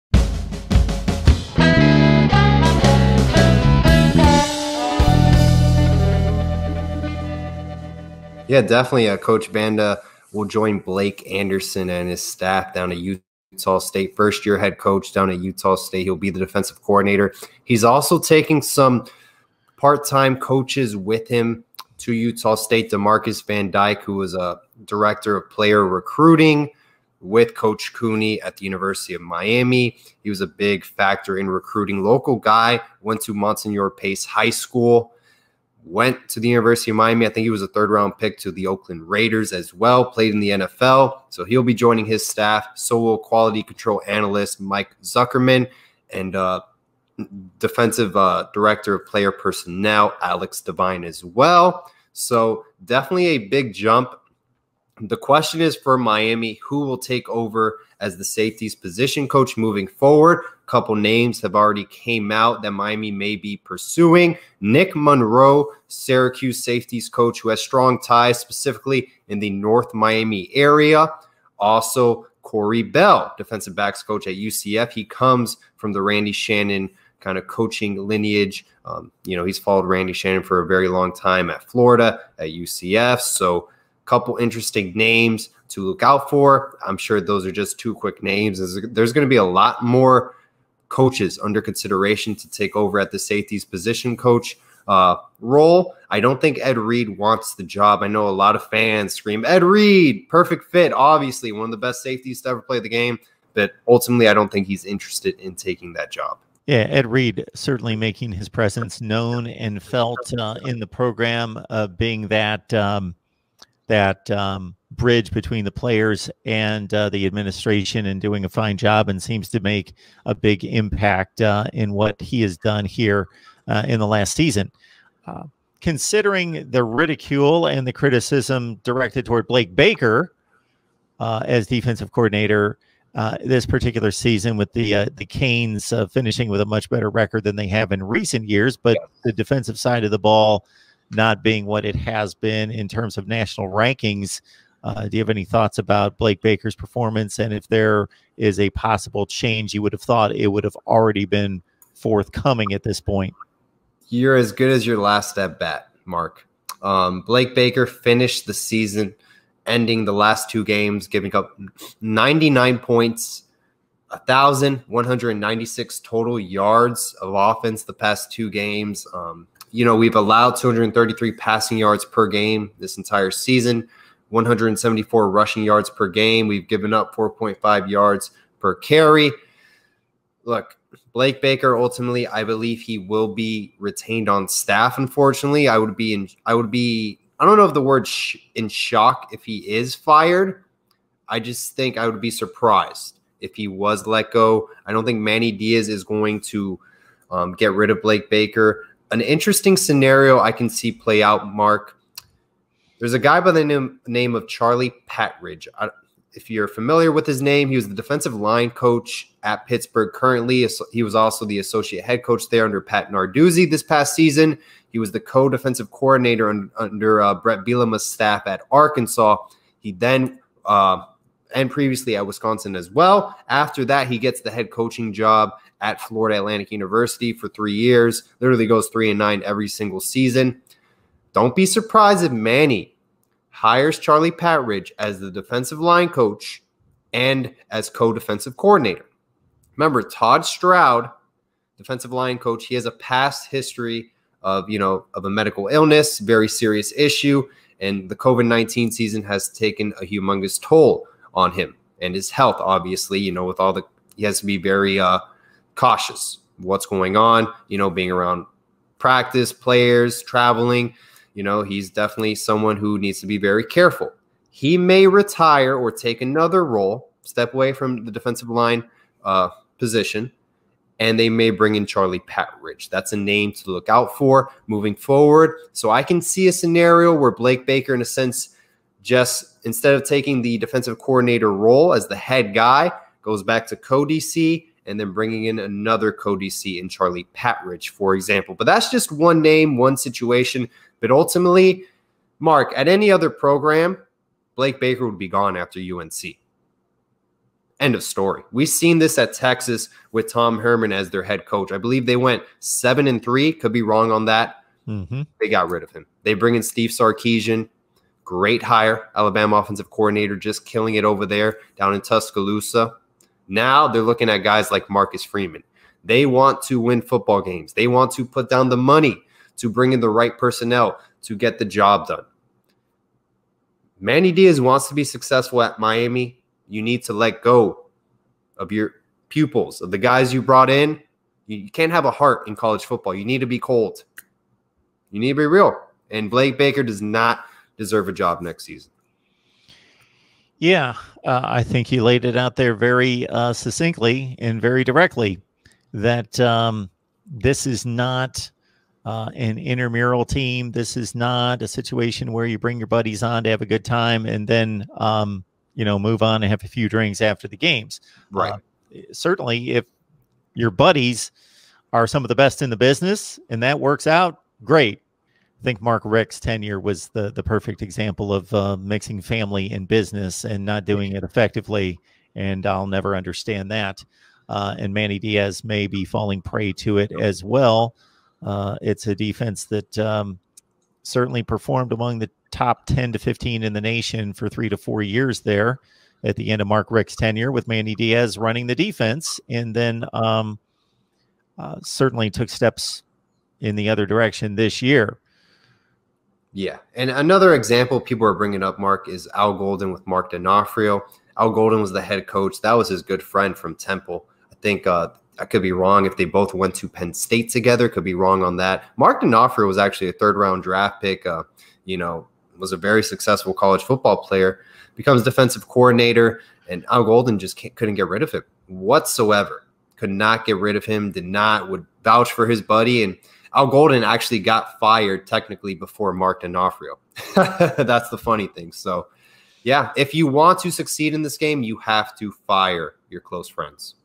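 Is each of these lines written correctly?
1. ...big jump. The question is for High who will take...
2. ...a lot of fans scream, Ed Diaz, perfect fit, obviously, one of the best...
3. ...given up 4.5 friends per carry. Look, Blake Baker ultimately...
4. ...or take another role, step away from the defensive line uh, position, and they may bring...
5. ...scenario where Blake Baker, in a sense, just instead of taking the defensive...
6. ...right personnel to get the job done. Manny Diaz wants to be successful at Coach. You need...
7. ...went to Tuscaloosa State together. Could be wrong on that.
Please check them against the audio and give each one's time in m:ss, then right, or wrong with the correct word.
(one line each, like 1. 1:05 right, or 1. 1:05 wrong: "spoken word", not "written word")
1. 0:53 wrong: "Miami", not "High"
2. 1:38 wrong: "Reed", not "Diaz"
3. 2:56 wrong: "yards", not "friends"
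4. 4:25 right
5. 4:36 right
6. 5:20 wrong: "Miami", not "Coach"
7. 6:46 wrong: "Penn", not "Tuscaloosa".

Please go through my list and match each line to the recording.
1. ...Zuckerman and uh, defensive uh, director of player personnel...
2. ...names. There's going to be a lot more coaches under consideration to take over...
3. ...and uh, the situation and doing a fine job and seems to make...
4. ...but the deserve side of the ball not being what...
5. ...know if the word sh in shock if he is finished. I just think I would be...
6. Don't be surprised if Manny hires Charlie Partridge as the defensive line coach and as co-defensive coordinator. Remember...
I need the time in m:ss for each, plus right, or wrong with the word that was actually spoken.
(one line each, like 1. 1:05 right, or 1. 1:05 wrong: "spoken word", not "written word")
1. 0:45 right
2. 1:28 right
3. 1:56 wrong: "administration", not "situation"
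4. 2:18 wrong: "defensive", not "deserve"
5. 3:07 wrong: "fired", not "finished"
6. 3:51 right.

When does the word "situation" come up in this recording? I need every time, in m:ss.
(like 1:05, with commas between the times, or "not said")
4:49, 5:51.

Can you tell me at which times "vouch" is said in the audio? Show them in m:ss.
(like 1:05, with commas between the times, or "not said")
7:02.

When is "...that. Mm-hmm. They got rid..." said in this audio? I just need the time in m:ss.
5:04.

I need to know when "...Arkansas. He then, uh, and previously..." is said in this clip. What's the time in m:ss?
3:38.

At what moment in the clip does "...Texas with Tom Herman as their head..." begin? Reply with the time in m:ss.
4:59.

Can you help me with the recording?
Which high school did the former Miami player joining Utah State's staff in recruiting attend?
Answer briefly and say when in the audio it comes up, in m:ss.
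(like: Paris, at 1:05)
Monsignor Pace High School, at 0:33.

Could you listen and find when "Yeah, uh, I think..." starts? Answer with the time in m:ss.
5:40.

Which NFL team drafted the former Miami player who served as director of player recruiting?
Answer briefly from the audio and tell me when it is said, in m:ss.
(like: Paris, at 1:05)
Oakland Raiders, at 0:38.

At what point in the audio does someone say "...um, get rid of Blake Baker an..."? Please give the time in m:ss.
3:17.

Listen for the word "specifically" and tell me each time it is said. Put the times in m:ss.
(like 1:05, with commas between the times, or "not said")
1:08.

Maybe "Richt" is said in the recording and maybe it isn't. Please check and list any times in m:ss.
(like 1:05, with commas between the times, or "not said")
6:06, 6:26.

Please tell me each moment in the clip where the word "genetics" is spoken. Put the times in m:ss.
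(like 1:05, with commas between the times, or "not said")
not said.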